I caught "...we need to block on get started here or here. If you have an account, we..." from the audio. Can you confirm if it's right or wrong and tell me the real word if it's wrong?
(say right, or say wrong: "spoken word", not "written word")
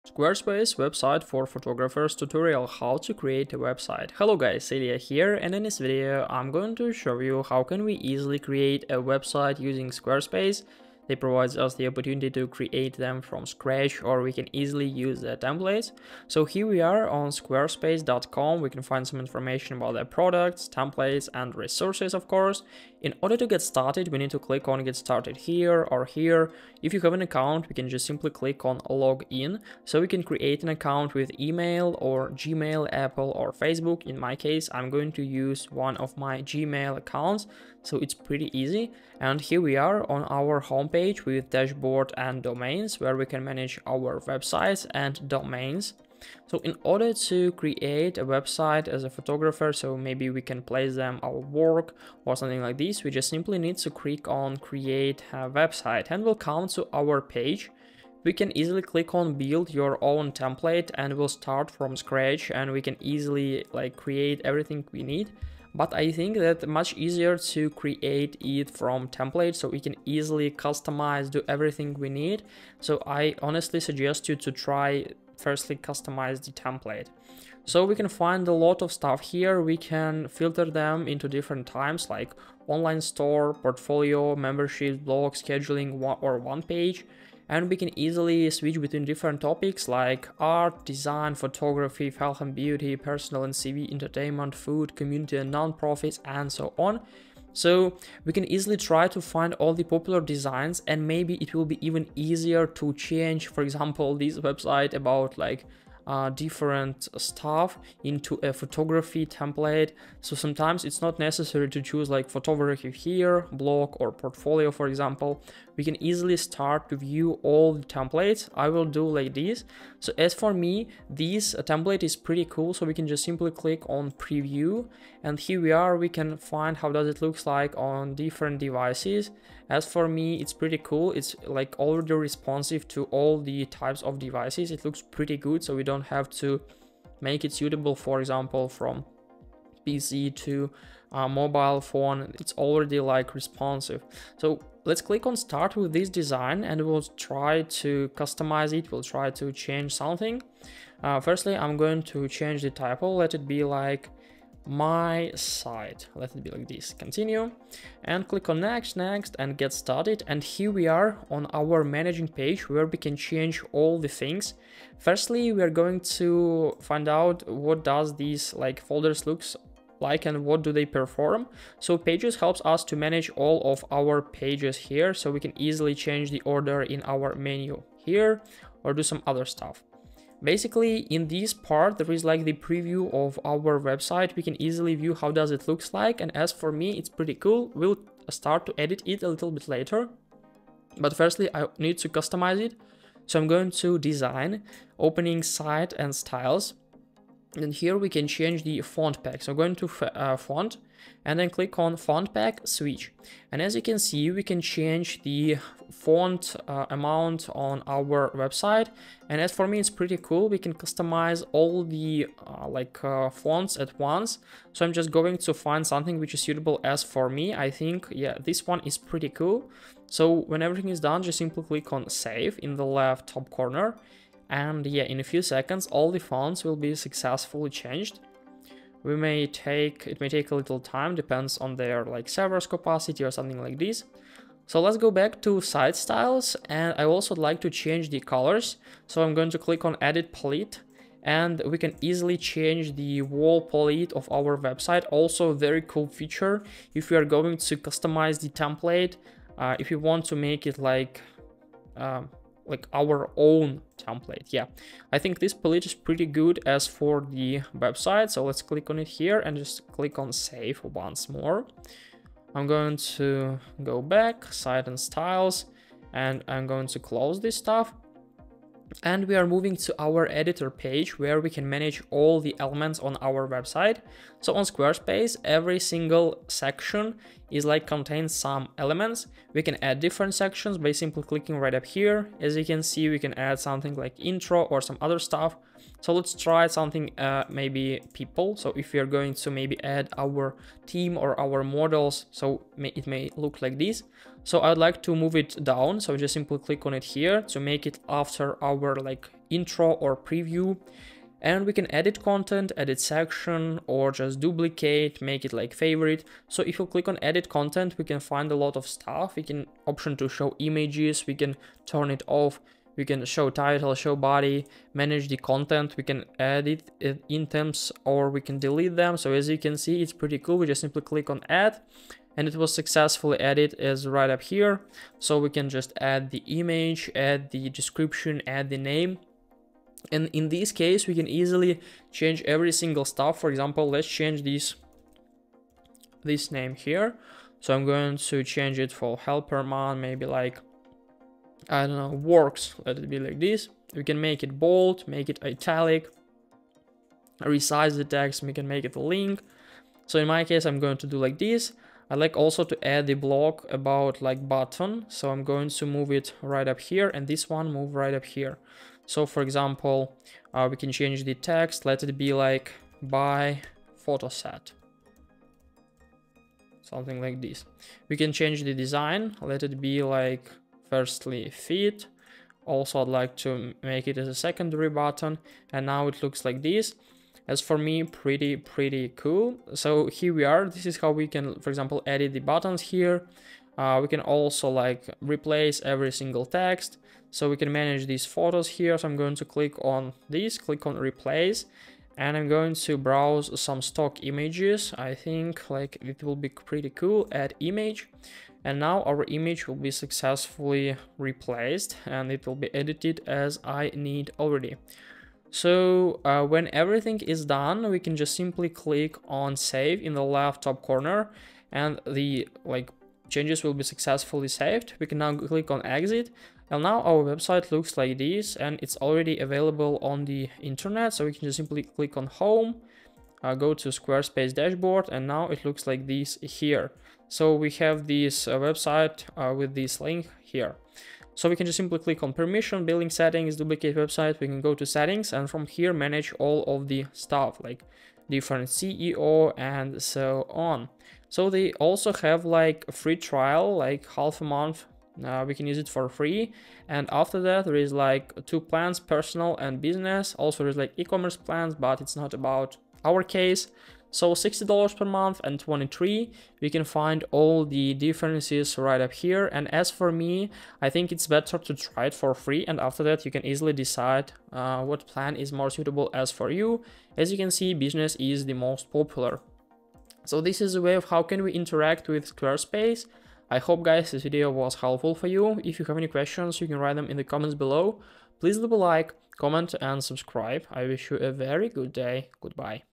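wrong: "click", not "block".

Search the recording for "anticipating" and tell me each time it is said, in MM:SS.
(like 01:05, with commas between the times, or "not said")
not said.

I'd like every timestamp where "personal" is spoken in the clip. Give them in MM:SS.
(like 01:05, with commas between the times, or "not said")
01:32, 07:28.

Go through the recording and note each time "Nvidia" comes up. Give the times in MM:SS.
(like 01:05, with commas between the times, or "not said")
not said.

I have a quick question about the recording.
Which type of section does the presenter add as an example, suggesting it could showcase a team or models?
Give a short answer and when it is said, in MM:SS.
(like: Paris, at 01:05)
People, at 04:48.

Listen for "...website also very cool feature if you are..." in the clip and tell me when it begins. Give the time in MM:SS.
04:04.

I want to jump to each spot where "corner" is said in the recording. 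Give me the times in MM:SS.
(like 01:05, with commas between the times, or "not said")
03:43, 06:50.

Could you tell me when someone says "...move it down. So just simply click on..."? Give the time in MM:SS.
04:55.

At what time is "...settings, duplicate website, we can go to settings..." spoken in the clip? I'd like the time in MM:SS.
07:13.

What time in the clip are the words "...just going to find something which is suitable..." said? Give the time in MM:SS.
03:34.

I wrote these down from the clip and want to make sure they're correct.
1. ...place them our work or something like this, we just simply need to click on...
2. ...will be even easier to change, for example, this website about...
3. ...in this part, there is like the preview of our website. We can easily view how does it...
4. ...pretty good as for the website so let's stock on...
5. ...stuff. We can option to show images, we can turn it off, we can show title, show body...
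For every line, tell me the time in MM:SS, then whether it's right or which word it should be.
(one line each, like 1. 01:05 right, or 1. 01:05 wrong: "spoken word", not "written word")
1. 00:50 right
2. 01:41 right
3. 03:01 right
4. 04:15 wrong: "click", not "stock"
5. 05:08 right.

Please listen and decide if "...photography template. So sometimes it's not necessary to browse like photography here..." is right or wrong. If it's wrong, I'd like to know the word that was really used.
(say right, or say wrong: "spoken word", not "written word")
wrong: "choose", not "browse".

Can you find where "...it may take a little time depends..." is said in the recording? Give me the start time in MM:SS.
03:50.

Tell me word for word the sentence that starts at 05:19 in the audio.
So as you can see, it's pretty cool.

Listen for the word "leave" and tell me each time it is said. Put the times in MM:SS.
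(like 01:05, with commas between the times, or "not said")
07:58.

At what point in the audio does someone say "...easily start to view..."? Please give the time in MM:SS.
01:56.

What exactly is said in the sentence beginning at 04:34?
So on Squarespace, every single section is like contains some elements.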